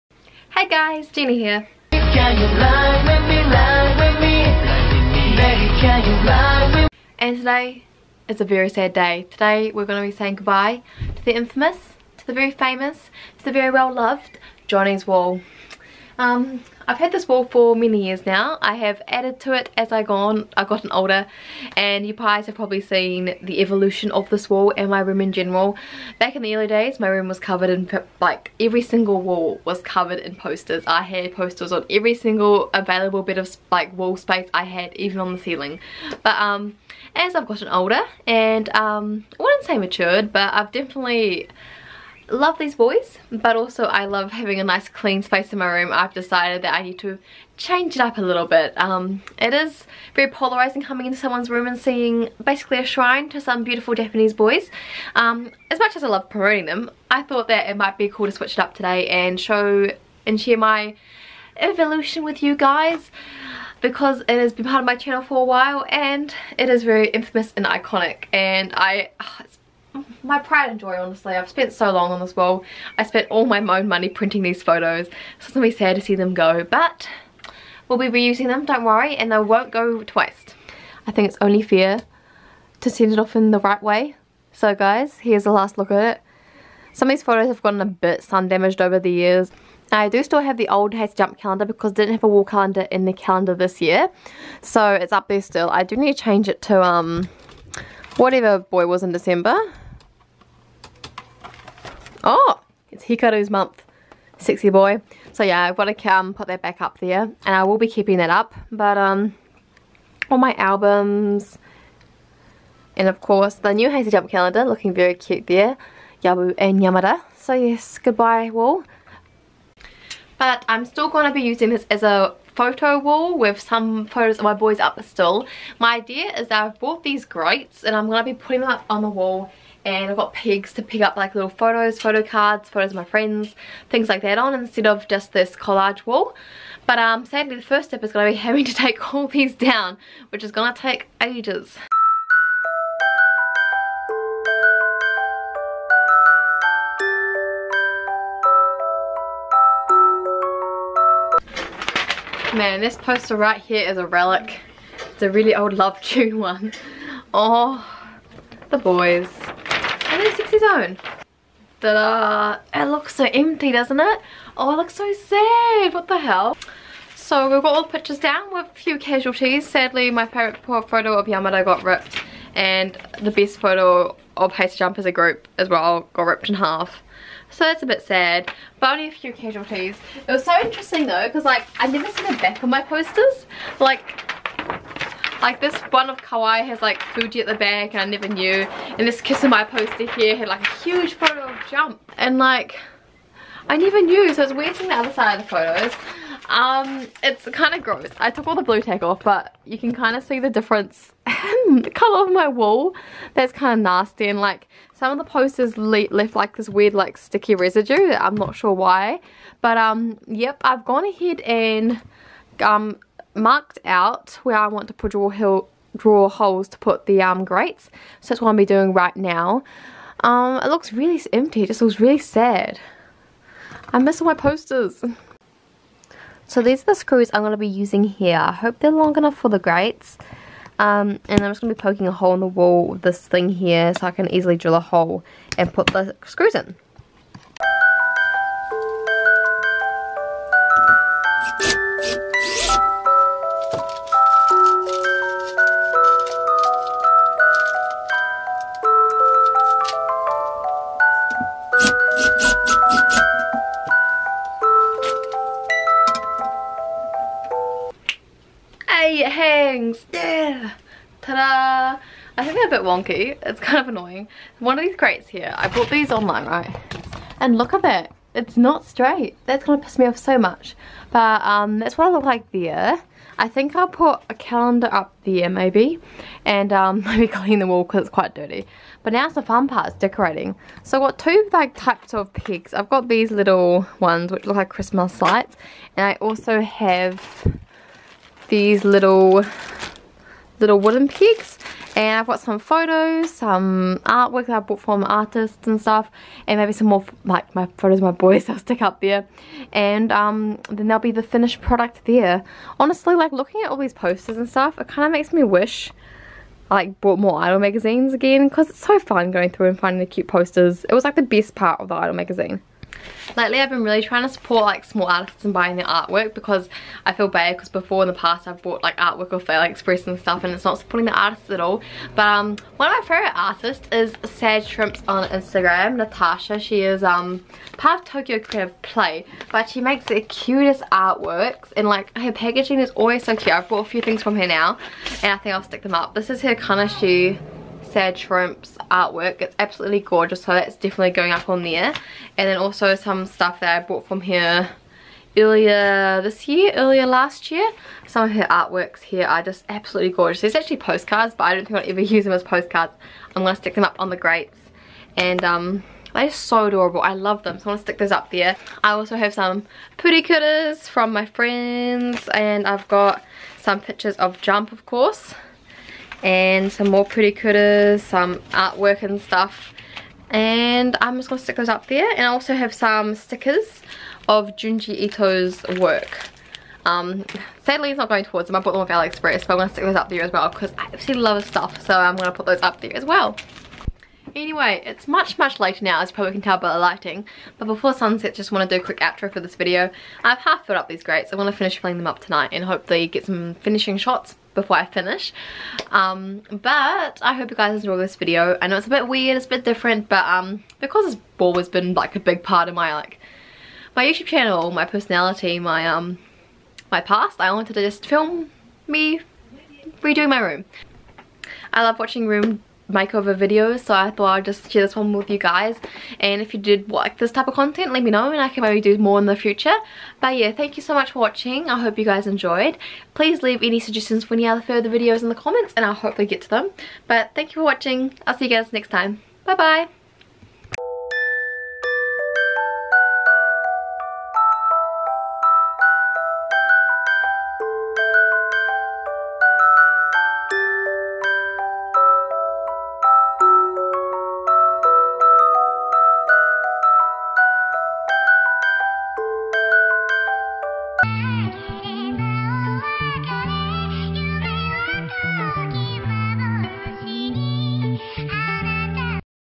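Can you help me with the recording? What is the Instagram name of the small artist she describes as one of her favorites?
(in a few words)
Sad Shrimps.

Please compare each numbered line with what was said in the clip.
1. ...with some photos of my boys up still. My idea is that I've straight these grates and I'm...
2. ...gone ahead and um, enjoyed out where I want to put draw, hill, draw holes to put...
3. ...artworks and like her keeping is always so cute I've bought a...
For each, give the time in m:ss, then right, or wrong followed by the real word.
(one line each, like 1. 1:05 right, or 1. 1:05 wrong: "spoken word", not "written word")
1. 2:03 wrong: "bought", not "straight"
2. 3:30 wrong: "marked", not "enjoyed"
3. 5:30 wrong: "packaging", not "keeping".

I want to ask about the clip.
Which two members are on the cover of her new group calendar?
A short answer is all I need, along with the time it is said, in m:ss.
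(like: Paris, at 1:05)
Yabu and Yamada, at 1:56.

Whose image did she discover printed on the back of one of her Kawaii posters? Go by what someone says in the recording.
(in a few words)
Fuji.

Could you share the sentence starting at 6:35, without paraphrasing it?
Um, but I hope you guys enjoy this video.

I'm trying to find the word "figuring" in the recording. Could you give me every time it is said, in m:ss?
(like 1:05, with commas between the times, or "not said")
not said.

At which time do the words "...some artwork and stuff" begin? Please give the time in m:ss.
6:08.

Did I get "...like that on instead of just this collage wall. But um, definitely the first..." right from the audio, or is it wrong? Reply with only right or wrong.
wrong.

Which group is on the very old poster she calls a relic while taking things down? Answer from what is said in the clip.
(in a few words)
Love Tune.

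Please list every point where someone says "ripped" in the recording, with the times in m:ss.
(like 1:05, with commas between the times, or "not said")
2:51, 2:56.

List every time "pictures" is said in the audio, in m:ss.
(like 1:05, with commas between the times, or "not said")
2:47, 6:03.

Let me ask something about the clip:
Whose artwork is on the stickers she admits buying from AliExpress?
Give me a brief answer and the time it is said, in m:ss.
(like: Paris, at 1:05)
Junji Ito, at 6:14.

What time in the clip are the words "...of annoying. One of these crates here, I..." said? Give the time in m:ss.
4:23.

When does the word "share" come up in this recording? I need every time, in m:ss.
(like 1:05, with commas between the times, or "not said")
1:00, 6:54.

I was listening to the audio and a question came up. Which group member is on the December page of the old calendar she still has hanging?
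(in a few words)
Hikaru.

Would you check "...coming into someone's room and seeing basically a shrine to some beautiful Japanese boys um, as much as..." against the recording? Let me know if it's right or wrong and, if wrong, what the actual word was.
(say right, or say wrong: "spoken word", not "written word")
right.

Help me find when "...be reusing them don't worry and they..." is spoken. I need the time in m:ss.
1:17.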